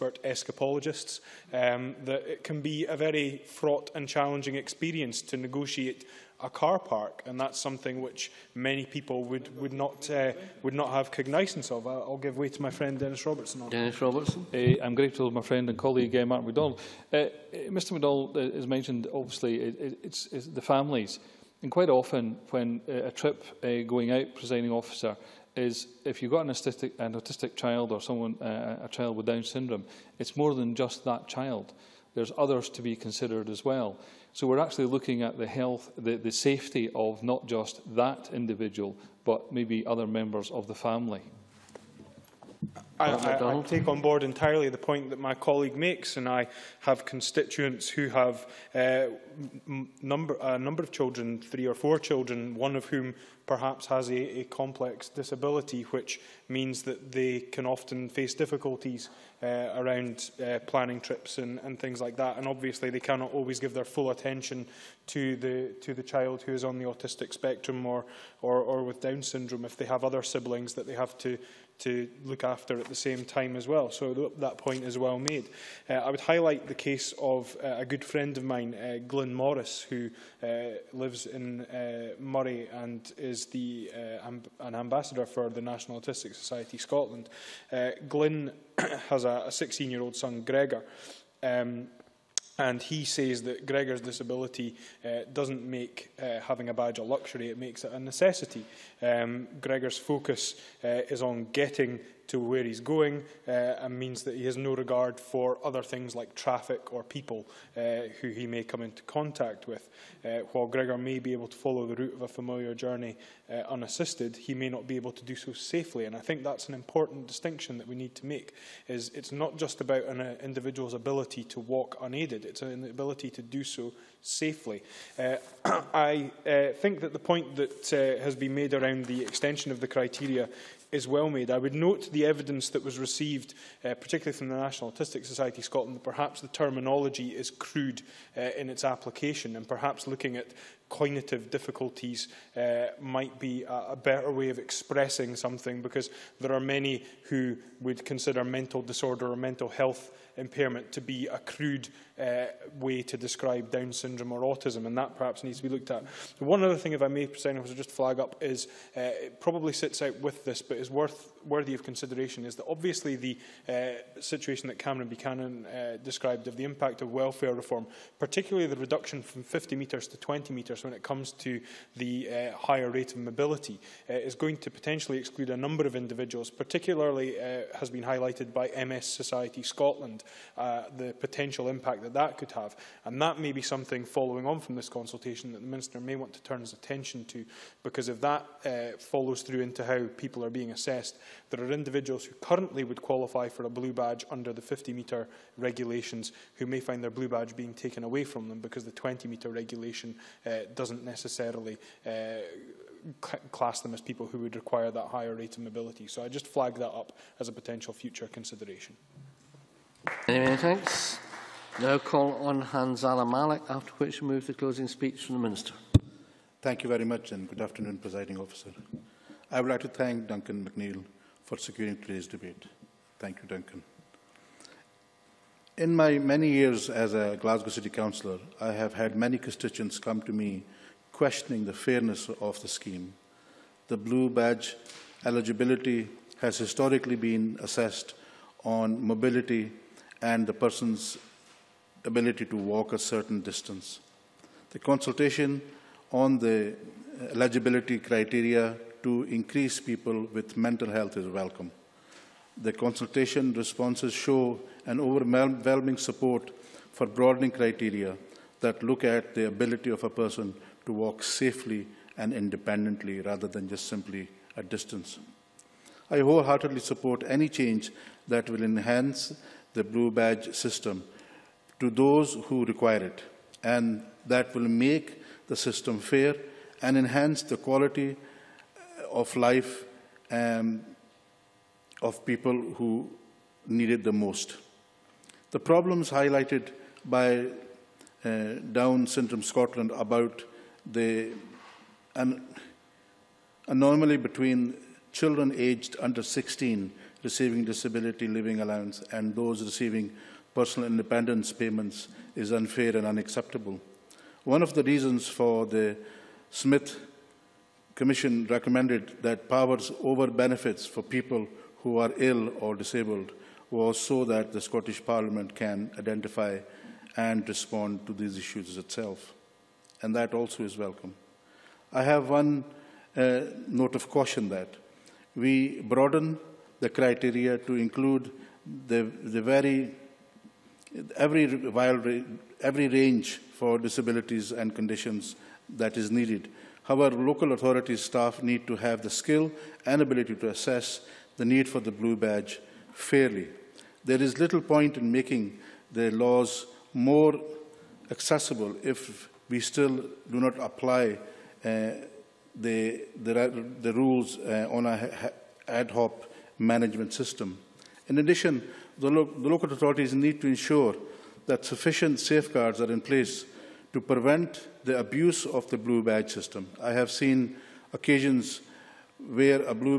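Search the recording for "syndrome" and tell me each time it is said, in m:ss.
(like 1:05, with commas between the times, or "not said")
0:29, 1:09, 2:33, 4:49.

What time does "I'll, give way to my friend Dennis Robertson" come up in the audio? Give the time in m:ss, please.
0:11.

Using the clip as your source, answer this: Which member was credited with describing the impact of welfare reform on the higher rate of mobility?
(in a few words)
Cameron Buchanan.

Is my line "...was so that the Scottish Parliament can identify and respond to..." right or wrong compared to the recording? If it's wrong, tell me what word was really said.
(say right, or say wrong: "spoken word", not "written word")
right.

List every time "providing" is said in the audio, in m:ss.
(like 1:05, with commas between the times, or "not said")
not said.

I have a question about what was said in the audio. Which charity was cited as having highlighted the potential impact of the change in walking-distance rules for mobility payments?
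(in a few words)
MS Society Scotland.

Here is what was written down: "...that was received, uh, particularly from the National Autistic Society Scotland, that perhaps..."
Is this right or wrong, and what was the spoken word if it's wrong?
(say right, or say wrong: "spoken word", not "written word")
right.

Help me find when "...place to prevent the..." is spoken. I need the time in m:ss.
6:02.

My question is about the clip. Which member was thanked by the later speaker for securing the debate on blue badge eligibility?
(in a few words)
Duncan McNeil.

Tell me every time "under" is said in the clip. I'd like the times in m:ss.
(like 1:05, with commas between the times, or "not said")
3:14, 4:55.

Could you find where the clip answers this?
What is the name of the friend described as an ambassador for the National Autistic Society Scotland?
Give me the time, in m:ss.
1:19.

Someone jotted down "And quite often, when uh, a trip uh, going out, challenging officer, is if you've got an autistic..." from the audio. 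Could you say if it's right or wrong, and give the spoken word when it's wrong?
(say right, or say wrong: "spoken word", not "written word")
wrong: "presiding", not "challenging".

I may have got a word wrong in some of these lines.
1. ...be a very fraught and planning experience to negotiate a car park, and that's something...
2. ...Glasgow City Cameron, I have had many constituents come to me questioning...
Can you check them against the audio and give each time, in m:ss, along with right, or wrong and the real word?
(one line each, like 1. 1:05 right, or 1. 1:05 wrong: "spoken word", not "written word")
1. 0:02 wrong: "challenging", not "planning"
2. 3:47 wrong: "Councillor", not "Cameron".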